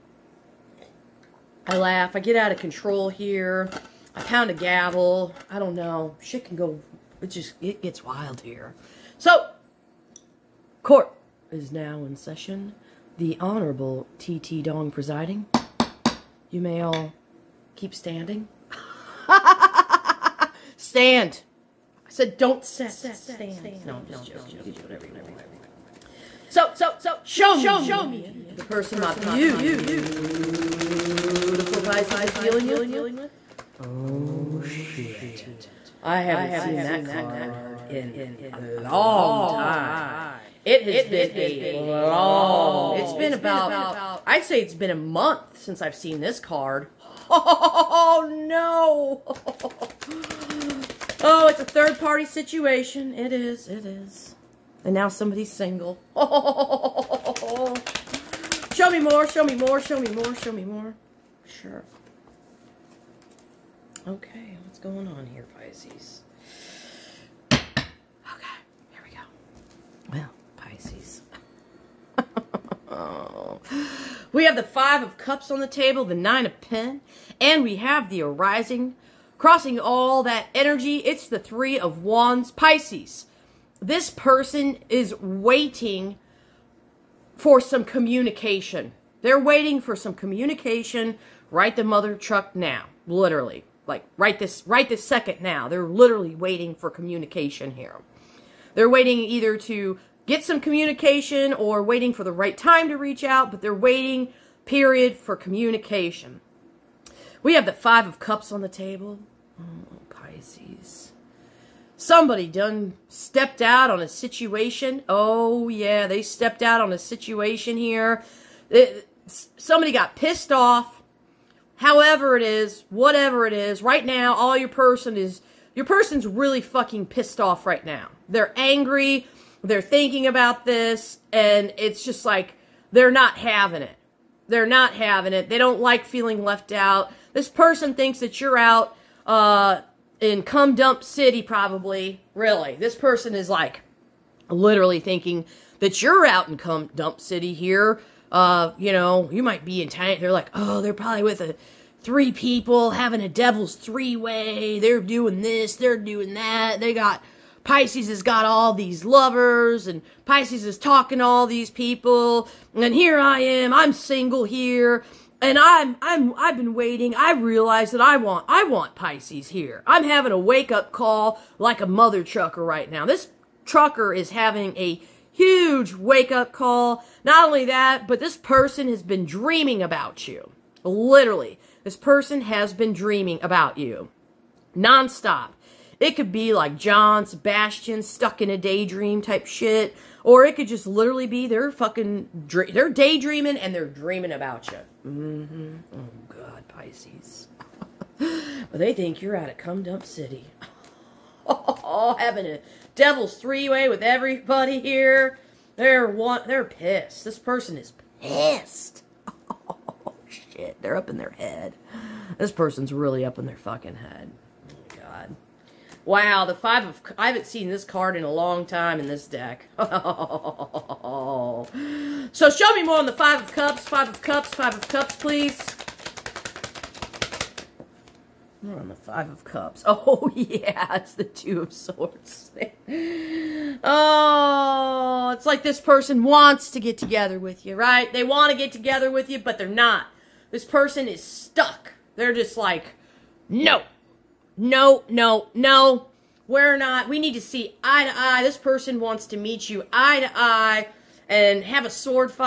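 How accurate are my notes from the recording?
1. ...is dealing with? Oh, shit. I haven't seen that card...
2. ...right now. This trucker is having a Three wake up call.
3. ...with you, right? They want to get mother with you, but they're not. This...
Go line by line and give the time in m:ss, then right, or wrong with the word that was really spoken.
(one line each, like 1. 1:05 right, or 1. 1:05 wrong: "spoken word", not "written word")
1. 0:32 right
2. 2:52 wrong: "Huge", not "Three"
3. 3:57 wrong: "together", not "mother".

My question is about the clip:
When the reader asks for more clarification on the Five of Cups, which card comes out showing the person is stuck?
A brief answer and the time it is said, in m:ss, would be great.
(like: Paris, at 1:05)
Two of Swords, at 3:51.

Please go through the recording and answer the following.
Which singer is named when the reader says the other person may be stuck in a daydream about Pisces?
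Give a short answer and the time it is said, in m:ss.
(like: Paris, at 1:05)
John Sebastian, at 3:06.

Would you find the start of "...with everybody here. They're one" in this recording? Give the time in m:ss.
3:23.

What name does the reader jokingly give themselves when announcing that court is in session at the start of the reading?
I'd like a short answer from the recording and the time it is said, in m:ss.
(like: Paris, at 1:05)
T.T. Dong, at 0:14.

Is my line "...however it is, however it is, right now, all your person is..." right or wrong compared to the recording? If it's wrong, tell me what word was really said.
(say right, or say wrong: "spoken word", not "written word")
wrong: "whatever", not "however".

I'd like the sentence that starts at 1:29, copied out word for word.
They're waiting for some communication Write the mother truck now, literally.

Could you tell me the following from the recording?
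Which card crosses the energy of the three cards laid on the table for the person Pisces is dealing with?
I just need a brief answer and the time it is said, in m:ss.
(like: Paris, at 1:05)
Three of Wands, at 1:21.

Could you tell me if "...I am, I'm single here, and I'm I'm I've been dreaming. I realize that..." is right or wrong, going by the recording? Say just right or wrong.
wrong.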